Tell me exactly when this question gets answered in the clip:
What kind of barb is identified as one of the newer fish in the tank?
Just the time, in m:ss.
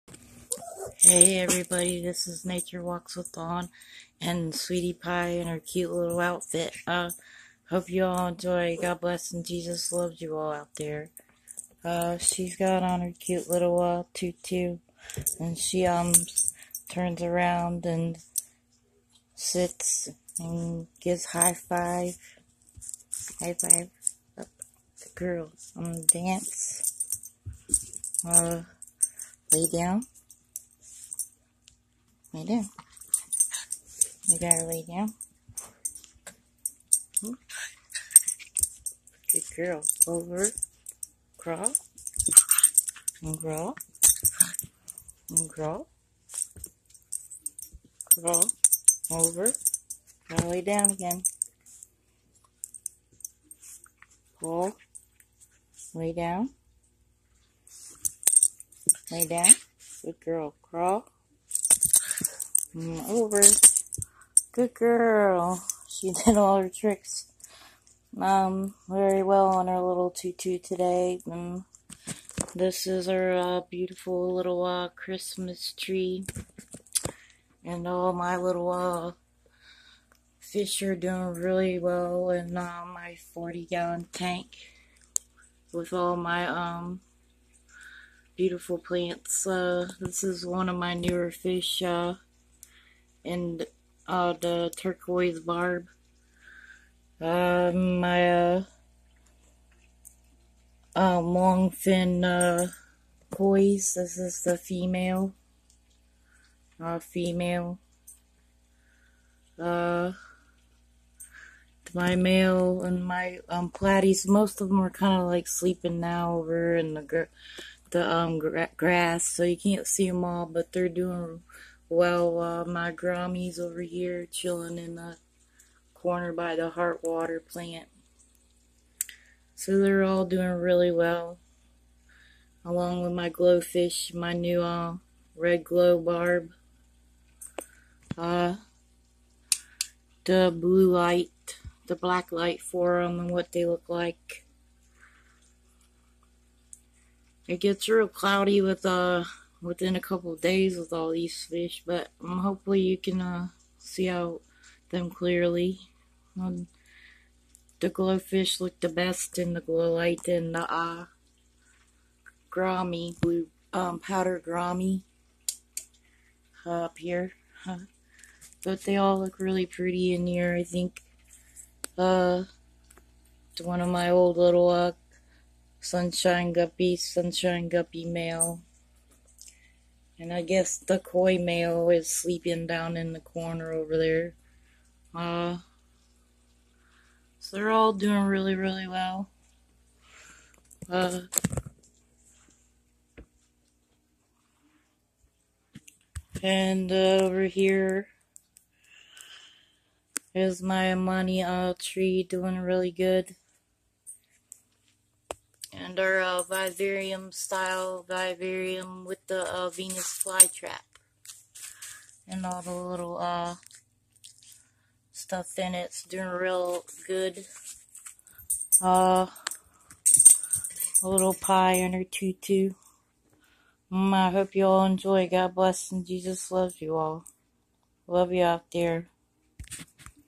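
1:34.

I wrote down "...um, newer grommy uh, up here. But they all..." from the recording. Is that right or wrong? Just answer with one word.
wrong.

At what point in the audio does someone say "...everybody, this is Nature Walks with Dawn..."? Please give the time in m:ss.
0:01.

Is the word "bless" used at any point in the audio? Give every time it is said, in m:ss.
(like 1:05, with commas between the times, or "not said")
0:09, 3:45.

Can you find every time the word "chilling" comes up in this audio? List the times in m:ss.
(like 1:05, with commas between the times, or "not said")
2:04.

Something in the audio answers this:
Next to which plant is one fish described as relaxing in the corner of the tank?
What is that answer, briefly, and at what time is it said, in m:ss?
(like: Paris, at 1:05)
heart water plant, at 2:06.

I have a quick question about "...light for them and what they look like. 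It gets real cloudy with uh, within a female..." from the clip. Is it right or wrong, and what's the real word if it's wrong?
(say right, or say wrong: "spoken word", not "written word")
wrong: "couple", not "female".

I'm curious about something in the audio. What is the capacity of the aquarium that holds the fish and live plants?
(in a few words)
40 gallons.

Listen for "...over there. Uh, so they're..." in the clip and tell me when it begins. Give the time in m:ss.
3:03.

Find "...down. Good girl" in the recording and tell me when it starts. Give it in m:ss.
0:59.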